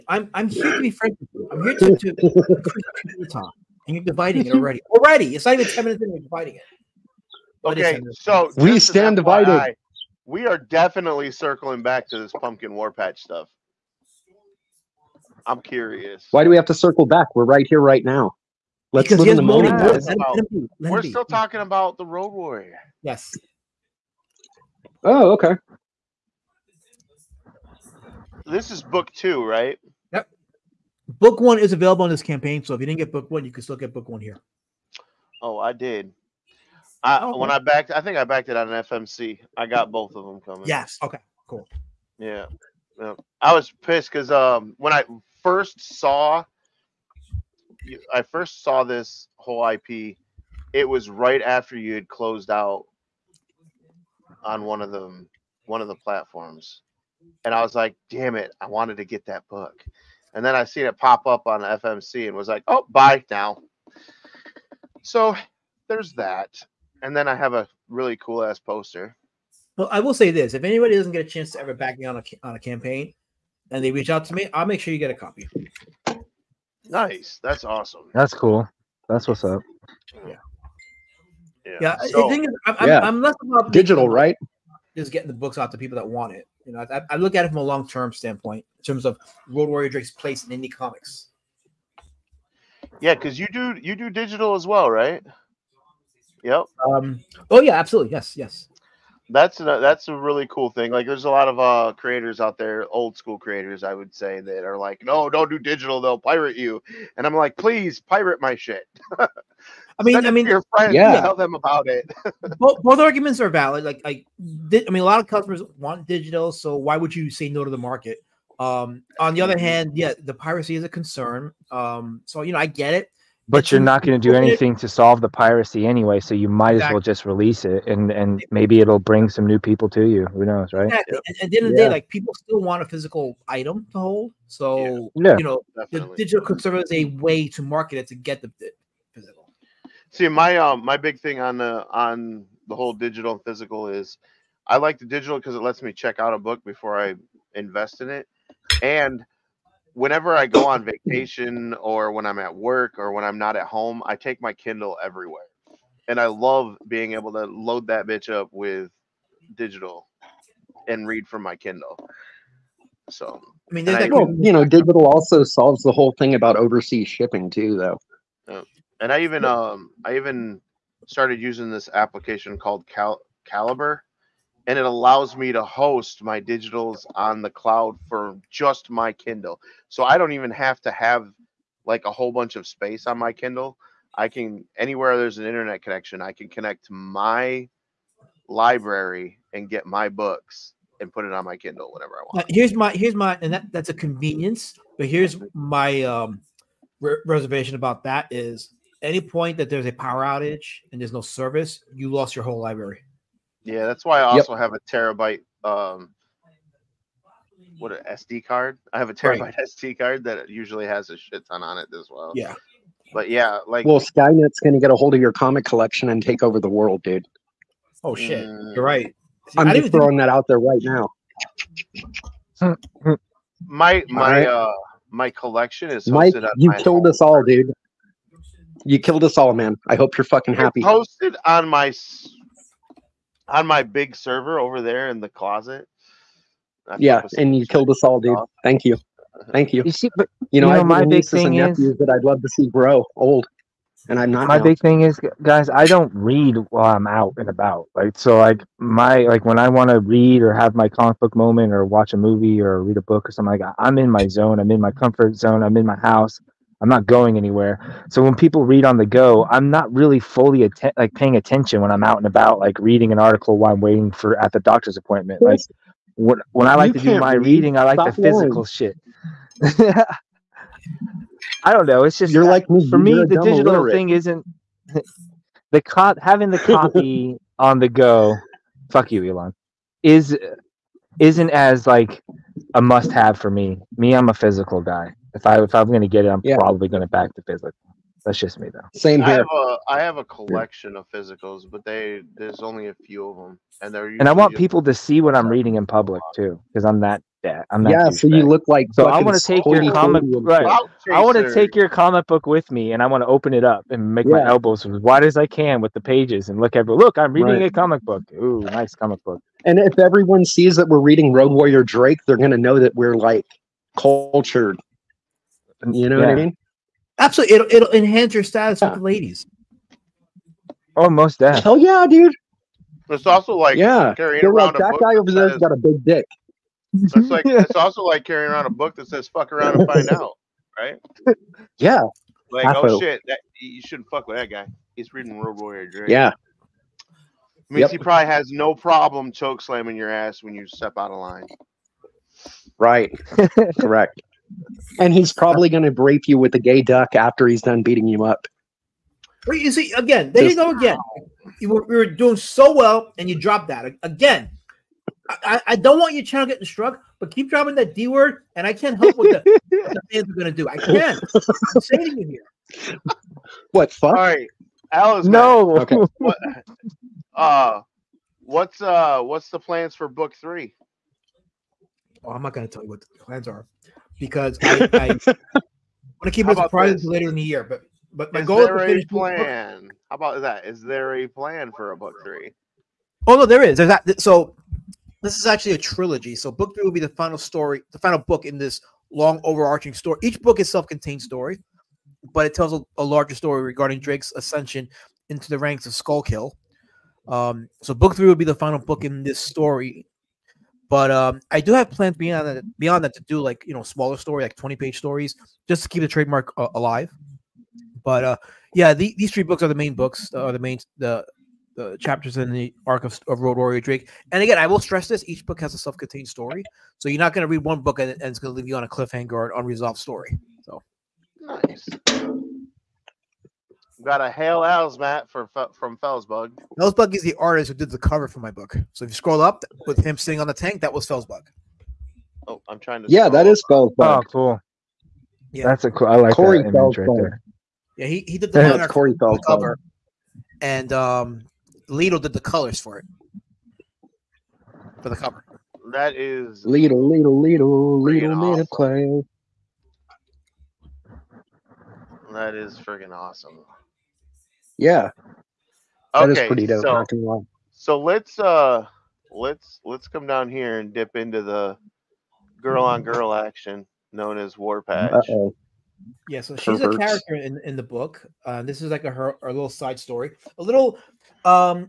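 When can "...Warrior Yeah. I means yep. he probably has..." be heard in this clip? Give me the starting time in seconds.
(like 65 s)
335 s.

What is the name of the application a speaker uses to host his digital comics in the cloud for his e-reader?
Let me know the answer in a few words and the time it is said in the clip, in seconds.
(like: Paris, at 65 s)
Calibre, at 173 s.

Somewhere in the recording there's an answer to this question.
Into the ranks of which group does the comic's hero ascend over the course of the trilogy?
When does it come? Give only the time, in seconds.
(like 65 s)
395 s.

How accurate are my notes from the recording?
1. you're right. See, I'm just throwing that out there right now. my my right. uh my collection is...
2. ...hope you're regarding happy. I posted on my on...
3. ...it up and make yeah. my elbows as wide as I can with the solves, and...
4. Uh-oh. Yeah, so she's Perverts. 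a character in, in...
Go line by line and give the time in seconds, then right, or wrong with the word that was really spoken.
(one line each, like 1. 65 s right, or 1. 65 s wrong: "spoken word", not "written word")
1. 218 s right
2. 229 s wrong: "fucking", not "regarding"
3. 303 s wrong: "pages", not "solves"
4. 465 s right.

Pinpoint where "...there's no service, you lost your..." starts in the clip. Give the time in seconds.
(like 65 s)
201 s.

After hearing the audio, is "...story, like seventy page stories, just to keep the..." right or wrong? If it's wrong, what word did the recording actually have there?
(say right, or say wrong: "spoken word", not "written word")
wrong: "twenty", not "seventy".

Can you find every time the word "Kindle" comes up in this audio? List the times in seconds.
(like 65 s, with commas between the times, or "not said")
154 s, 161 s, 179 s, 183 s, 191 s.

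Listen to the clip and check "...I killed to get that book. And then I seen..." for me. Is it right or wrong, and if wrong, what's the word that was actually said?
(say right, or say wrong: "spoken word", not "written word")
wrong: "wanted", not "killed".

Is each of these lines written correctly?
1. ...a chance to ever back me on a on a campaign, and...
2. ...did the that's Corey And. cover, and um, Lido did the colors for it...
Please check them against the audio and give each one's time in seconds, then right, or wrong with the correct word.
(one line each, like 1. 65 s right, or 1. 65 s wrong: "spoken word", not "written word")
1. 71 s right
2. 438 s wrong: "Felsbug", not "And".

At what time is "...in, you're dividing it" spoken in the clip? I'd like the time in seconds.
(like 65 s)
6 s.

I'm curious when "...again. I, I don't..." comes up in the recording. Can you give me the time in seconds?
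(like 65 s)
354 s.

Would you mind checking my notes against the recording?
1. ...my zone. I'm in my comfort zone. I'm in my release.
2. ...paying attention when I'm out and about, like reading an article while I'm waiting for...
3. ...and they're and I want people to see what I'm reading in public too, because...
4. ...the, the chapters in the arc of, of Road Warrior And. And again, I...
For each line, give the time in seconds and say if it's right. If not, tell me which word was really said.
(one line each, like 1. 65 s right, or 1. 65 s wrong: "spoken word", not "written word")
1. 254 s wrong: "house", not "release"
2. 261 s right
3. 293 s right
4. 410 s wrong: "Drake", not "And".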